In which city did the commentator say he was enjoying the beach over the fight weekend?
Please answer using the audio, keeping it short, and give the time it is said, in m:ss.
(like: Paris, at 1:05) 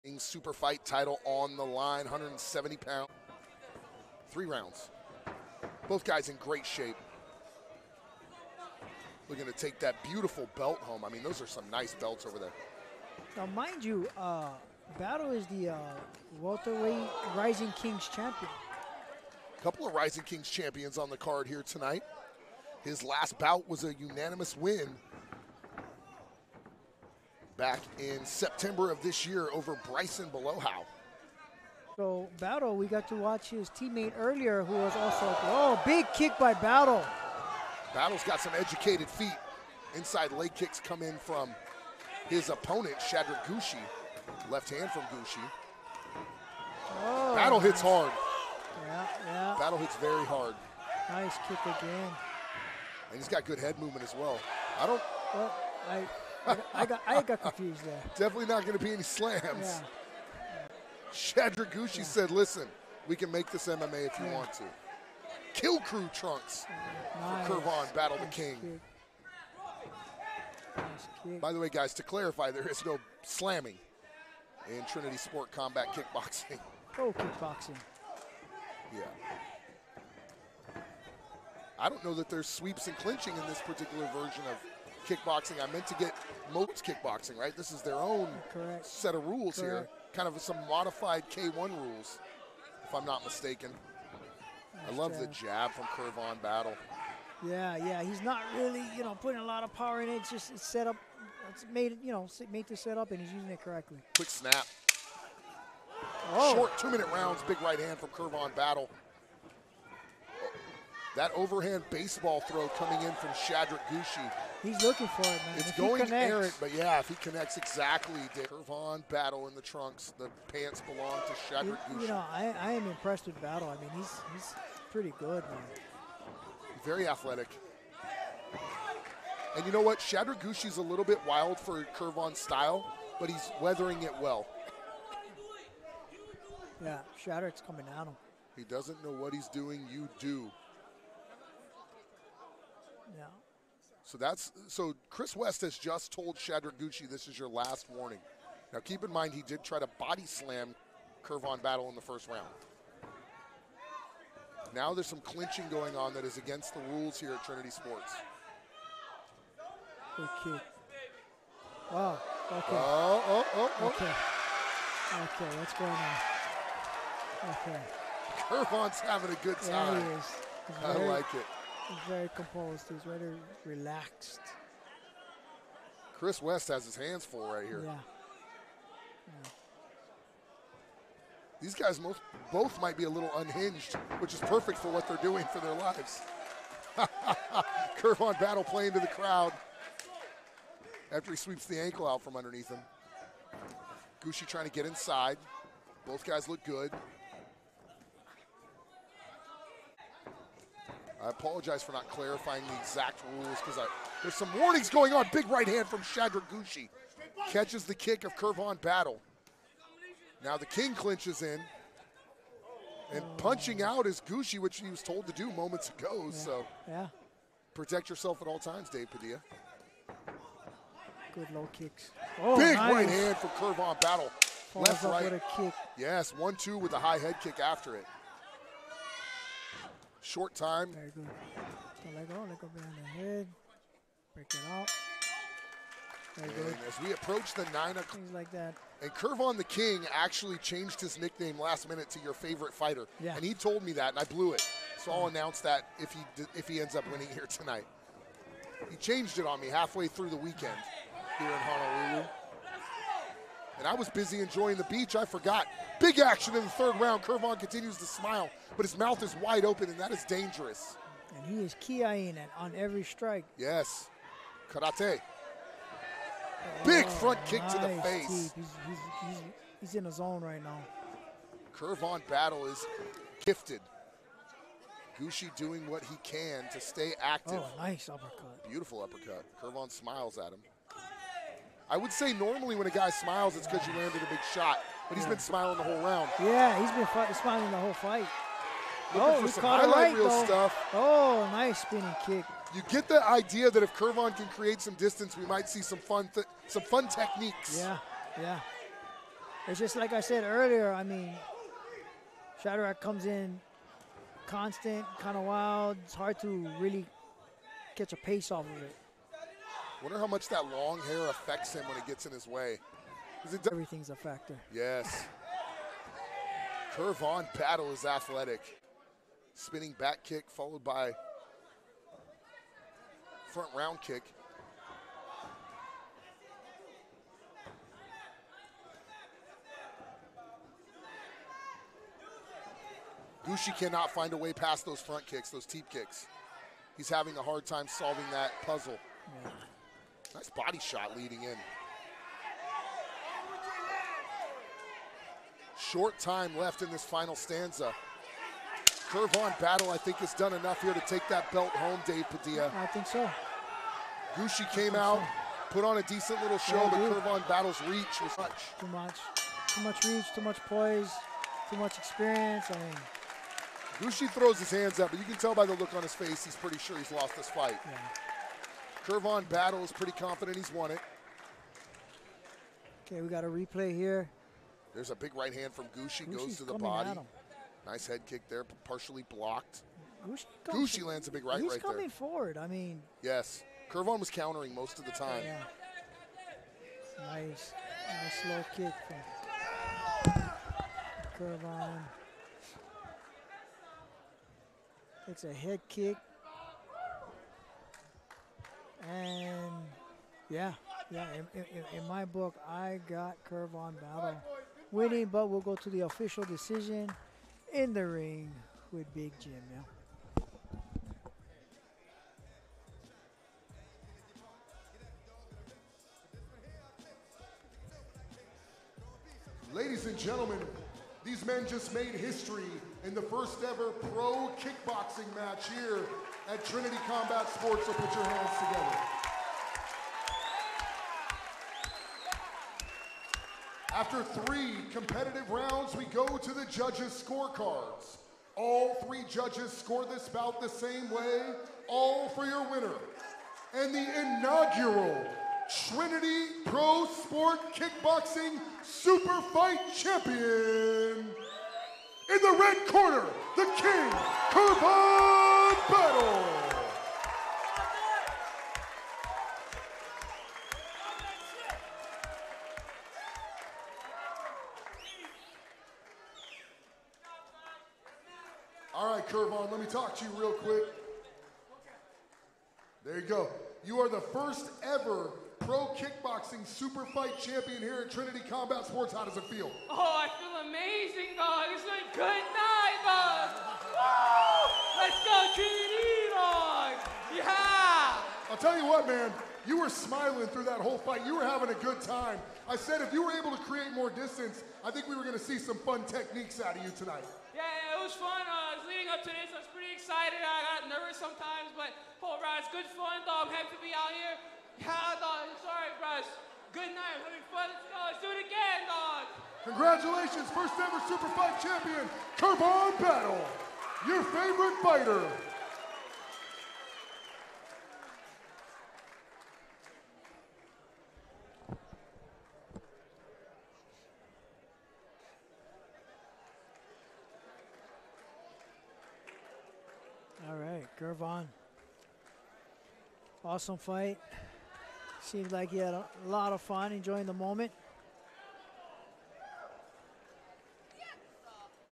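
Honolulu, at 4:11.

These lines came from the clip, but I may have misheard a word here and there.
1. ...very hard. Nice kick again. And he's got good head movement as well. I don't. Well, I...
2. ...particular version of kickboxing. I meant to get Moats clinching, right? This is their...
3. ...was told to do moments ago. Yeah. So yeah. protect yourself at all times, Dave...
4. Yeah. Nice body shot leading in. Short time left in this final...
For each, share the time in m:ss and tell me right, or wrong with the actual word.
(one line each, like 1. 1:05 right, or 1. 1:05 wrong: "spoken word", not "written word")
1. 0:49 right
2. 1:23 wrong: "kickboxing", not "clinching"
3. 3:34 right
4. 5:39 right.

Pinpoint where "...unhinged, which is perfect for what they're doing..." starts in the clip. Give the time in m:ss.
3:03.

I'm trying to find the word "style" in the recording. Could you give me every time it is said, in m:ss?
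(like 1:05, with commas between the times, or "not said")
2:12.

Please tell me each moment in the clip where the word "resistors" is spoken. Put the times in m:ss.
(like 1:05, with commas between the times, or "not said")
not said.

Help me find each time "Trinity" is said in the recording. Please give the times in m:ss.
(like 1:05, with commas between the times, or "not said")
1:14, 2:37, 7:06, 7:25, 7:58, 8:05.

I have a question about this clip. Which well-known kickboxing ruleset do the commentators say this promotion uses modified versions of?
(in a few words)
K1.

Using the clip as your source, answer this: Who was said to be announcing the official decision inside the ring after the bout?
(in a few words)
Big Jim.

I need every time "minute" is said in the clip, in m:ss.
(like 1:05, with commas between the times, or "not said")
1:46, 4:01.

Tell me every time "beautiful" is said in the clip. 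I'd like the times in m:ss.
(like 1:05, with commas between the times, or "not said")
0:10, 4:38.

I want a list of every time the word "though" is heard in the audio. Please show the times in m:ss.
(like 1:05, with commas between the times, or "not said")
4:50, 8:23.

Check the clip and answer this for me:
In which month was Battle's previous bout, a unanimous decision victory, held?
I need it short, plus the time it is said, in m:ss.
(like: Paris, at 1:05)
September, at 0:28.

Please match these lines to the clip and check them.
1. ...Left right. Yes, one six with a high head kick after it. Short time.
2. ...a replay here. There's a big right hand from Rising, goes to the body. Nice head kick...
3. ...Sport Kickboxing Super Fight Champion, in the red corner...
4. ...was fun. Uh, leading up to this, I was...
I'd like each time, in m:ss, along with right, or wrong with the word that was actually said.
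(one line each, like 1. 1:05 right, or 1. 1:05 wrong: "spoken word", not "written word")
1. 3:44 wrong: "two", not "six"
2. 6:13 wrong: "Gucci", not "Rising"
3. 7:27 right
4. 8:18 right.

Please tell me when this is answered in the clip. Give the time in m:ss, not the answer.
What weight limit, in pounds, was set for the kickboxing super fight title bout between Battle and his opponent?
0:02.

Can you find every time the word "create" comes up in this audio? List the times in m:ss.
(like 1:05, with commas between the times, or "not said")
4:54, 8:13.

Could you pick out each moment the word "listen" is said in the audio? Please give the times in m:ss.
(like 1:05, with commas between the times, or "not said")
1:02.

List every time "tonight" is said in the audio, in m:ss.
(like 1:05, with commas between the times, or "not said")
0:21, 4:07, 8:16.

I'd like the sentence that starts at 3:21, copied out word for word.
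I apologize for not clarifying the exact rules because there's some warnings going on.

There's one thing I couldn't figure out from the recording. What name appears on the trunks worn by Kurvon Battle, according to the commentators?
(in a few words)
Kill Crew.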